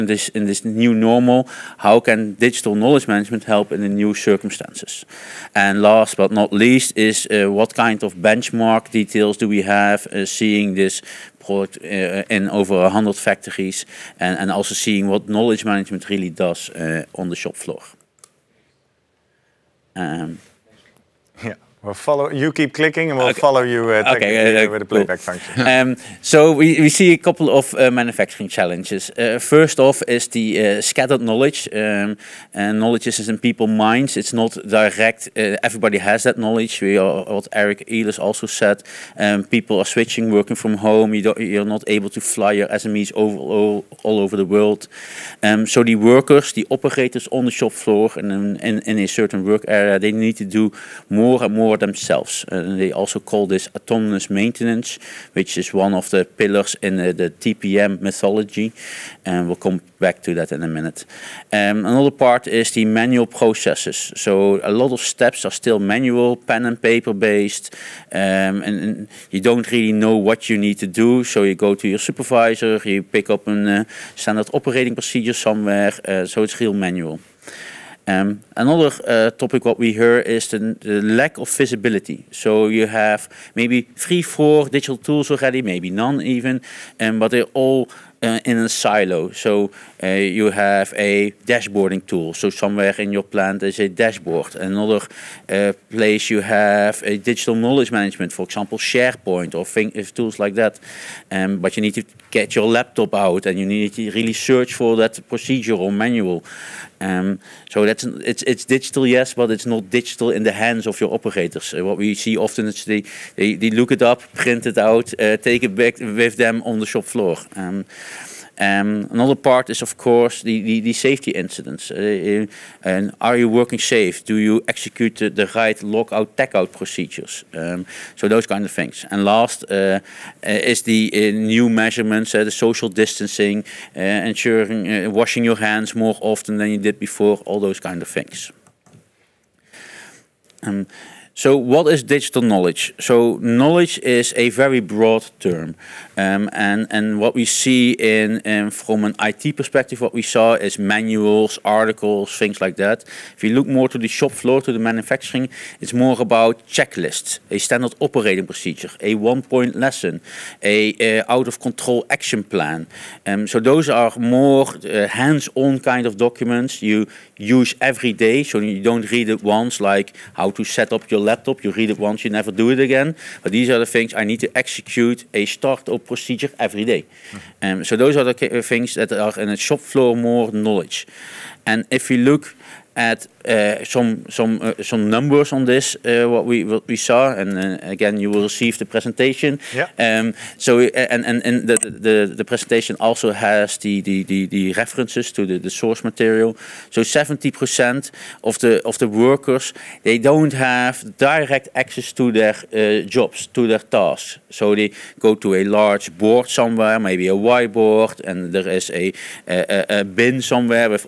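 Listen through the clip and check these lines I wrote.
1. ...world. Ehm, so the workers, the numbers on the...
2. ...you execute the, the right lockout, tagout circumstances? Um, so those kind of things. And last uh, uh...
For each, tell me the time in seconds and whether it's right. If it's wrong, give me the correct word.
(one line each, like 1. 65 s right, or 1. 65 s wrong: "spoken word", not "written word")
1. 44 s wrong: "operators", not "numbers"
2. 124 s wrong: "procedures", not "circumstances".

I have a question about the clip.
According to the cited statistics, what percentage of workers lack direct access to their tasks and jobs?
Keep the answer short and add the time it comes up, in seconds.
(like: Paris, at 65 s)
70%, at 197 s.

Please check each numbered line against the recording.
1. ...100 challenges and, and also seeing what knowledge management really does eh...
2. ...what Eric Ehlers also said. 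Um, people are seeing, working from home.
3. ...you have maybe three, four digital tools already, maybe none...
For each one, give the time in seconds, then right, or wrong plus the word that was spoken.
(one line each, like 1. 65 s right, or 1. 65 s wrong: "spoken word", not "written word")
1. 12 s wrong: "factories", not "challenges"
2. 37 s wrong: "switching", not "seeing"
3. 82 s right.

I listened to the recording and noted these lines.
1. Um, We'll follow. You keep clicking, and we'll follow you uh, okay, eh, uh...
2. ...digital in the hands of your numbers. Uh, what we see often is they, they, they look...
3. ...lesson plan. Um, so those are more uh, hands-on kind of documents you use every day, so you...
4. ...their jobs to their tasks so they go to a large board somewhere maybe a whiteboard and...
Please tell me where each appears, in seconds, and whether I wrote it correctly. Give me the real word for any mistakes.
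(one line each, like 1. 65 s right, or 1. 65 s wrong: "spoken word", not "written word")
1. 19 s right
2. 109 s wrong: "operators", not "numbers"
3. 162 s wrong: "action", not "lesson"
4. 202 s right.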